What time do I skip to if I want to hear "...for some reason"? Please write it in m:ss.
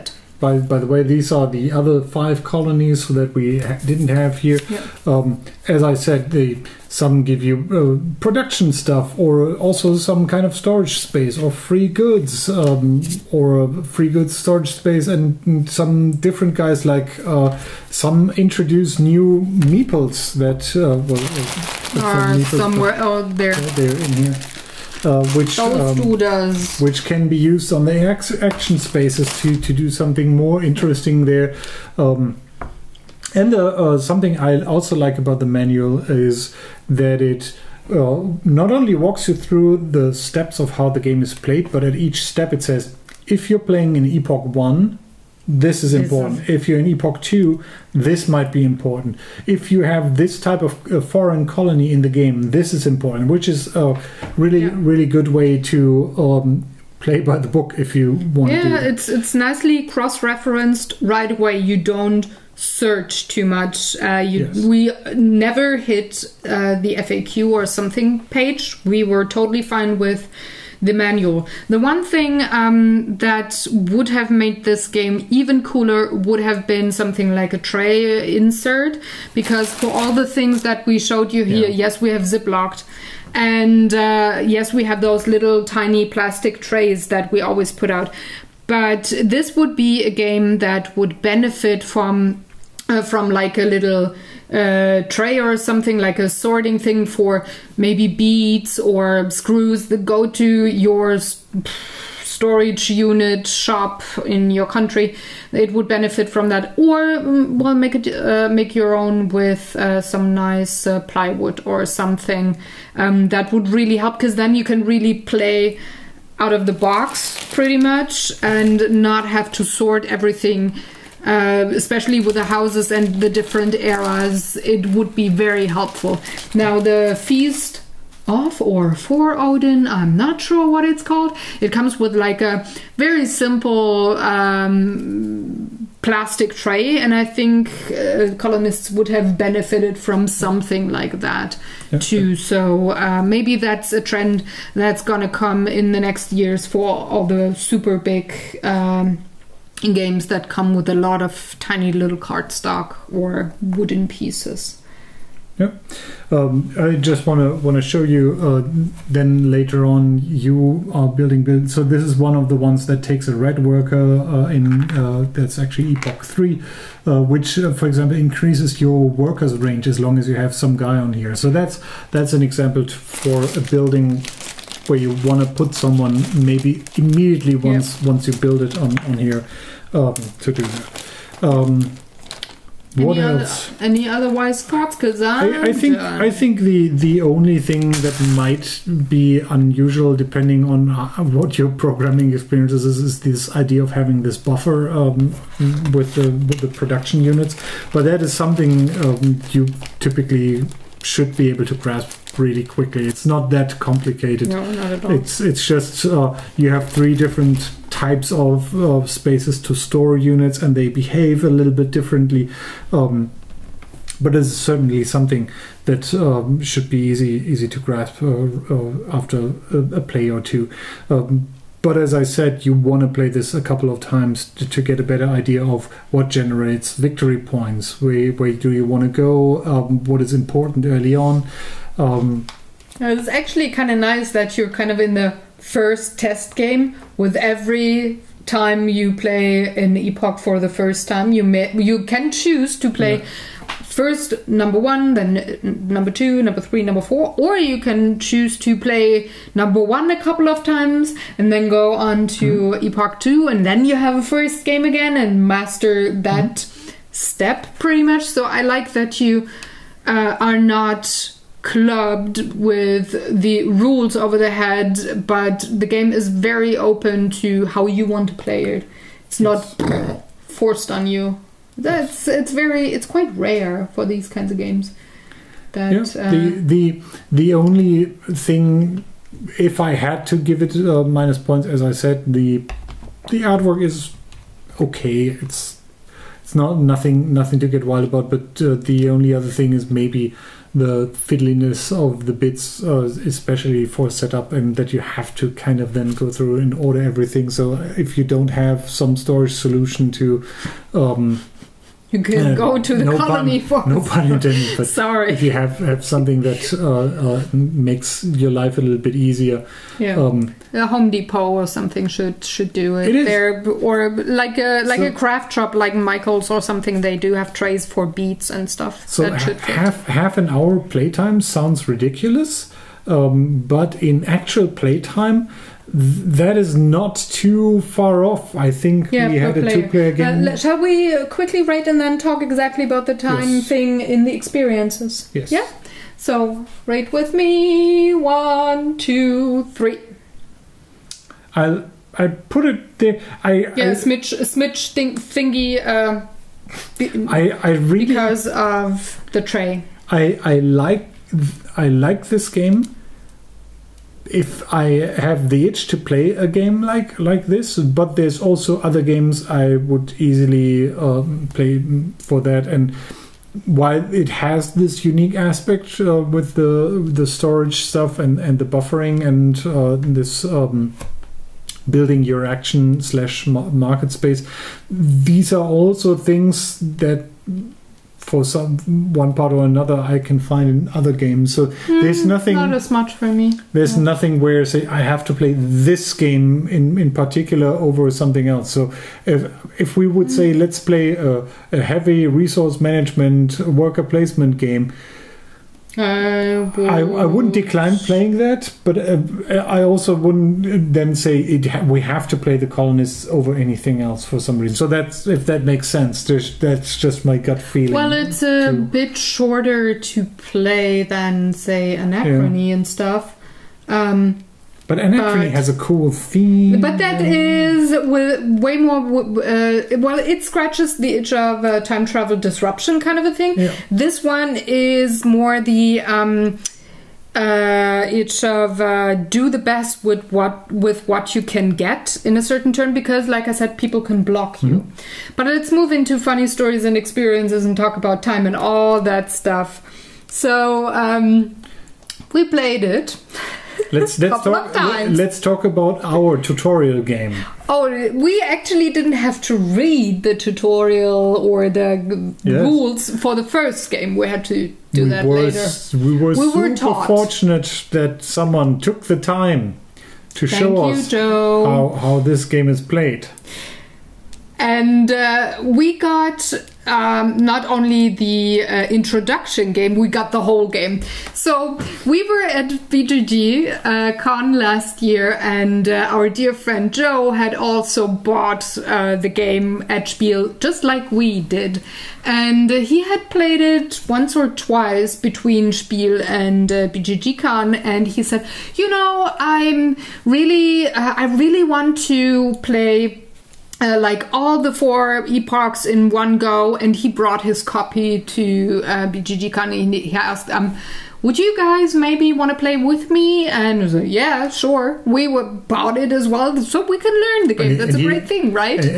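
6:44.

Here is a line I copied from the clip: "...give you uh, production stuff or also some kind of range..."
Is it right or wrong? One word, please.
wrong.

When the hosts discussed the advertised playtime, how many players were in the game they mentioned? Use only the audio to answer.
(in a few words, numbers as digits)
2.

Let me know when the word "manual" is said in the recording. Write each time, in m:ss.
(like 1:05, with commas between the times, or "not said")
0:35, 1:10.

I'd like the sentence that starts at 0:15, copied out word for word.
And, and some different guys, like uh, some introduce new meeples that uh, well, uh, are meeples, somewhere out there.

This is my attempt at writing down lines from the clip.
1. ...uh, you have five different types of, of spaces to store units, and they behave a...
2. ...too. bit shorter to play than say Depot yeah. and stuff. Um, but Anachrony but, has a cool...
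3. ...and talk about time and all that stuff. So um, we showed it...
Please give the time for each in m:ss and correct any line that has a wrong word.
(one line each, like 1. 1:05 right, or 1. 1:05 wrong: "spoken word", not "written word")
1. 3:26 wrong: "three", not "five"
2. 6:48 wrong: "Anachrony", not "Depot"
3. 7:17 wrong: "played", not "showed".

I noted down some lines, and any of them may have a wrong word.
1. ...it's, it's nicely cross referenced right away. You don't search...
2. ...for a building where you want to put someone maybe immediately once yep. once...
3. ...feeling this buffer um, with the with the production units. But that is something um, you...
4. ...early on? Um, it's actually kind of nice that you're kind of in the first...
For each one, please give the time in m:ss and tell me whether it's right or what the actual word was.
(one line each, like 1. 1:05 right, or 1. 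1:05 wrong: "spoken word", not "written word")
1. 0:58 right
2. 2:52 right
3. 3:13 wrong: "having", not "feeling"
4. 3:50 right.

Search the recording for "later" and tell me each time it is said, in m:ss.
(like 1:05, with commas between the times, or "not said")
2:39, 7:35.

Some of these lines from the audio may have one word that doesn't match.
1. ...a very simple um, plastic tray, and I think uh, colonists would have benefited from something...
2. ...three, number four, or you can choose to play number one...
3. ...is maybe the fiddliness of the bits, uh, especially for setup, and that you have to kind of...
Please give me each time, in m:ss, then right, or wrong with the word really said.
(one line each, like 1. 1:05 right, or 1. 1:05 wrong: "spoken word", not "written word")
1. 2:12 right
2. 4:06 right
3. 4:49 right.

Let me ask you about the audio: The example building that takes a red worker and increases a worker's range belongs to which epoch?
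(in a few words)
Epoch 3.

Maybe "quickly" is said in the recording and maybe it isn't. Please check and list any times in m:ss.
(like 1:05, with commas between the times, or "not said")
3:22, 5:31.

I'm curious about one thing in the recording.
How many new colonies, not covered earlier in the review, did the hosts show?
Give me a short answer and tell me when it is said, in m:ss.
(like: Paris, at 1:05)
5, at 0:02.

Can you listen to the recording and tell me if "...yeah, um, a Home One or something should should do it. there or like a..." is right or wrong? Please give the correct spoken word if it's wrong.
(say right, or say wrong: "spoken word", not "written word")
wrong: "Depot", not "One".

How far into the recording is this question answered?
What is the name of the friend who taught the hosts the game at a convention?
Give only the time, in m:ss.
7:56.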